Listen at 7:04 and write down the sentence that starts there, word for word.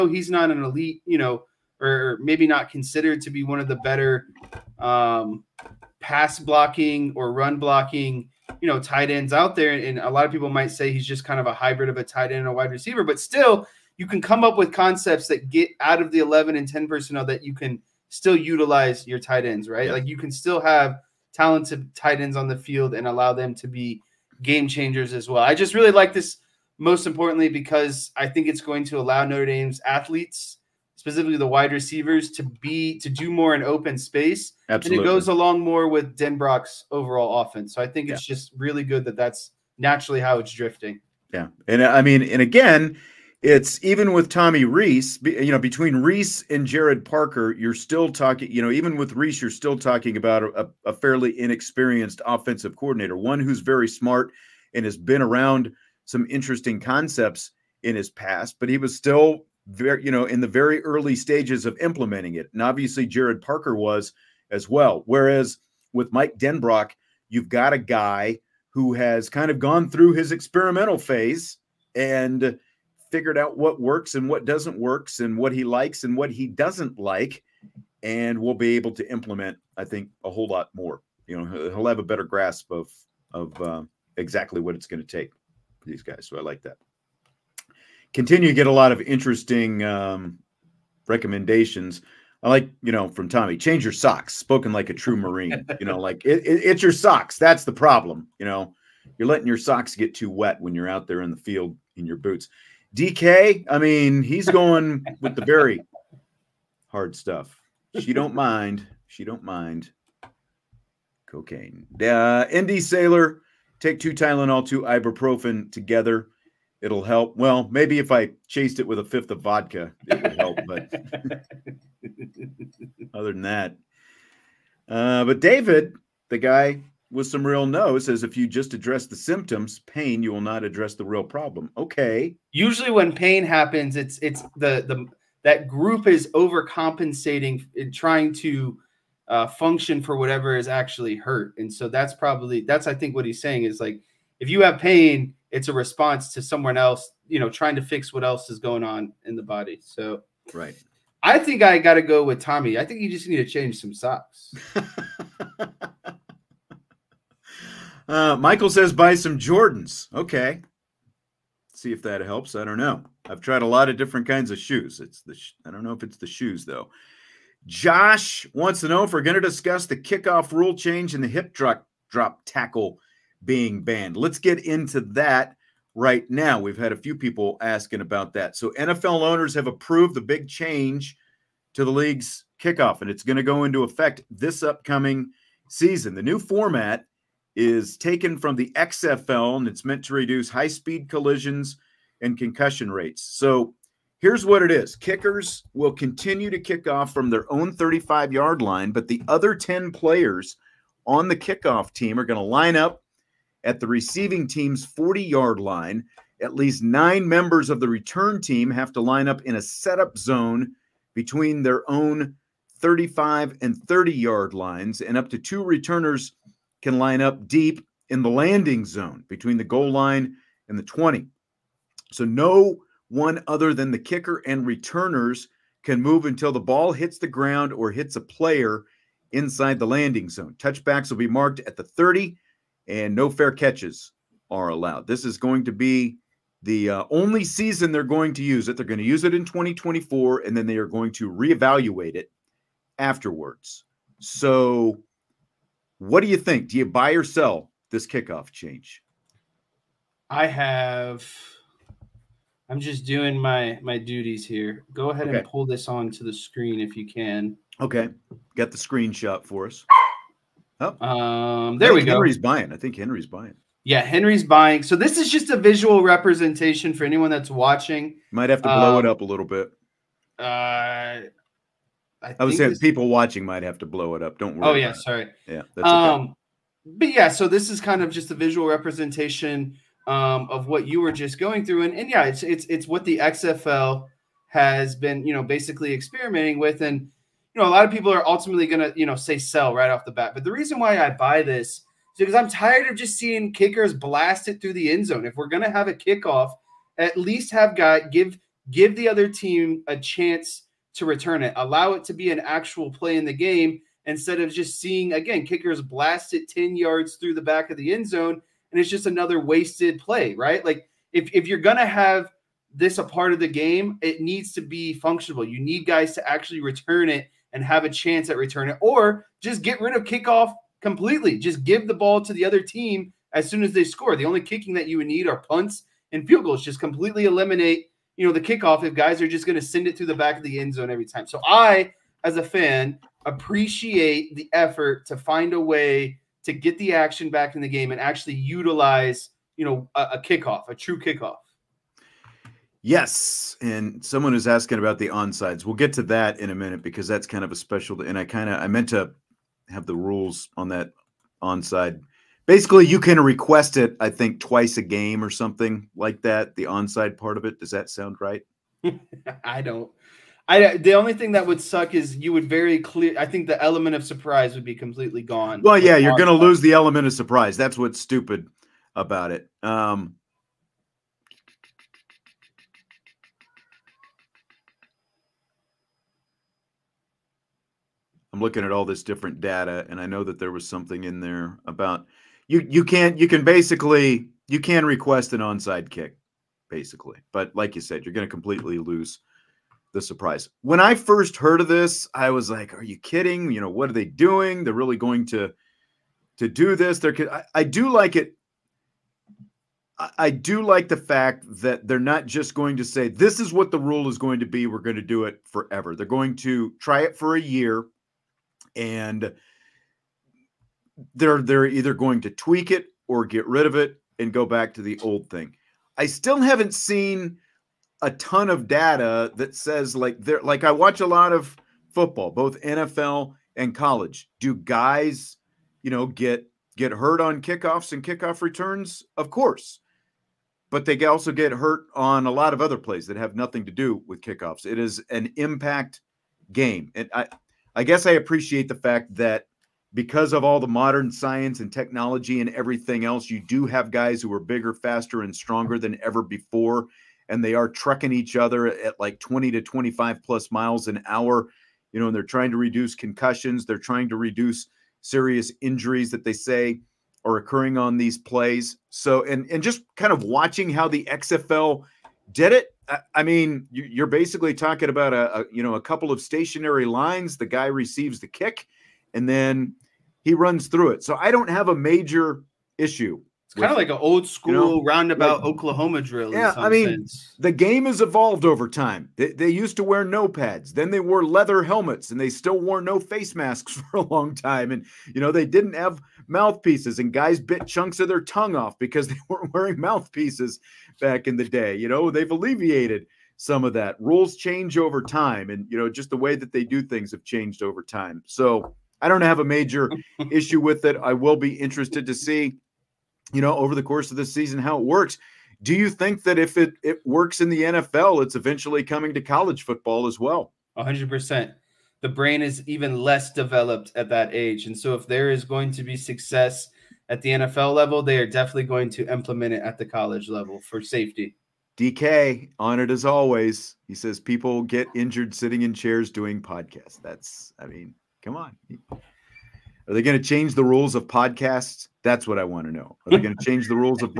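Do guys, you know, get get hurt on kickoffs and kickoff returns?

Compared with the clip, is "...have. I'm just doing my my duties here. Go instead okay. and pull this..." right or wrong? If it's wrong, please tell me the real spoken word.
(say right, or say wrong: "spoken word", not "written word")
wrong: "ahead", not "instead".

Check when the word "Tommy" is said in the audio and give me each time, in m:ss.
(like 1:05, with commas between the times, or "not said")
0:44, 1:33, 2:32.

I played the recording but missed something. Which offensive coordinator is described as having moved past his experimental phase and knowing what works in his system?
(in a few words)
Mike Denbrock.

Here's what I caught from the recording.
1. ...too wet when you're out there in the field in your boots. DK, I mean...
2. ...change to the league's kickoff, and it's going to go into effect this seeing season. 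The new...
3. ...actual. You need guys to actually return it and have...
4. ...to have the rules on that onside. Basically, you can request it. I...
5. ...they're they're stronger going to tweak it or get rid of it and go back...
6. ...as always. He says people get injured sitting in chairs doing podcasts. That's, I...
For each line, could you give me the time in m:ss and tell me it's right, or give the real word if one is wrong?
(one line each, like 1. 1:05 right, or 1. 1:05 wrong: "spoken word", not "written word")
1. 1:40 right
2. 3:00 wrong: "upcoming", not "seeing"
3. 5:14 wrong: "functional", not "actual"
4. 5:48 right
5. 6:51 wrong: "either", not "stronger"
6. 8:42 right.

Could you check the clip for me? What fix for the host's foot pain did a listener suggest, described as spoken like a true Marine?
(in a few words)
Change your socks.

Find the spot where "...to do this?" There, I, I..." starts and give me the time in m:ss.
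6:36.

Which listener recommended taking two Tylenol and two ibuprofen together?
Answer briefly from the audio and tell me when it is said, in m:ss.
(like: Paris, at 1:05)
Indy Sailor, at 1:52.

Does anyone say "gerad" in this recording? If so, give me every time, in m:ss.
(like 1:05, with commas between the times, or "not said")
0:46, 1:03.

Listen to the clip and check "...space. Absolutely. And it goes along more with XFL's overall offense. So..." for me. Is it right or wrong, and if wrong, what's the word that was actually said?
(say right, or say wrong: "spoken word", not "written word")
wrong: "Denbrock", not "XFL".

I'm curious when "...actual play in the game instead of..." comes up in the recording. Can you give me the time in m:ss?
5:02.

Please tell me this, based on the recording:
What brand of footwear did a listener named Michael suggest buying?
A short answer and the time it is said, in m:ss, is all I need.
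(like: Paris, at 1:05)
Jordans, at 2:39.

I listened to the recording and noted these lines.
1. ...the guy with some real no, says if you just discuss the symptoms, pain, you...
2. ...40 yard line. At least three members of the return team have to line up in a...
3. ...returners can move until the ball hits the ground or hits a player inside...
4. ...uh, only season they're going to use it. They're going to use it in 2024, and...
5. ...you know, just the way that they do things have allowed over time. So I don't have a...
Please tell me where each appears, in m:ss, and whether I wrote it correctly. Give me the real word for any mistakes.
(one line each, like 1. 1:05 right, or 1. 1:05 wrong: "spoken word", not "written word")
1. 2:06 wrong: "address", not "discuss"
2. 3:24 wrong: "nine", not "three"
3. 3:44 right
4. 3:56 right
5. 8:15 wrong: "changed", not "allowed".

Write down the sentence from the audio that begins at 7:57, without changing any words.
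the game has evolved over time.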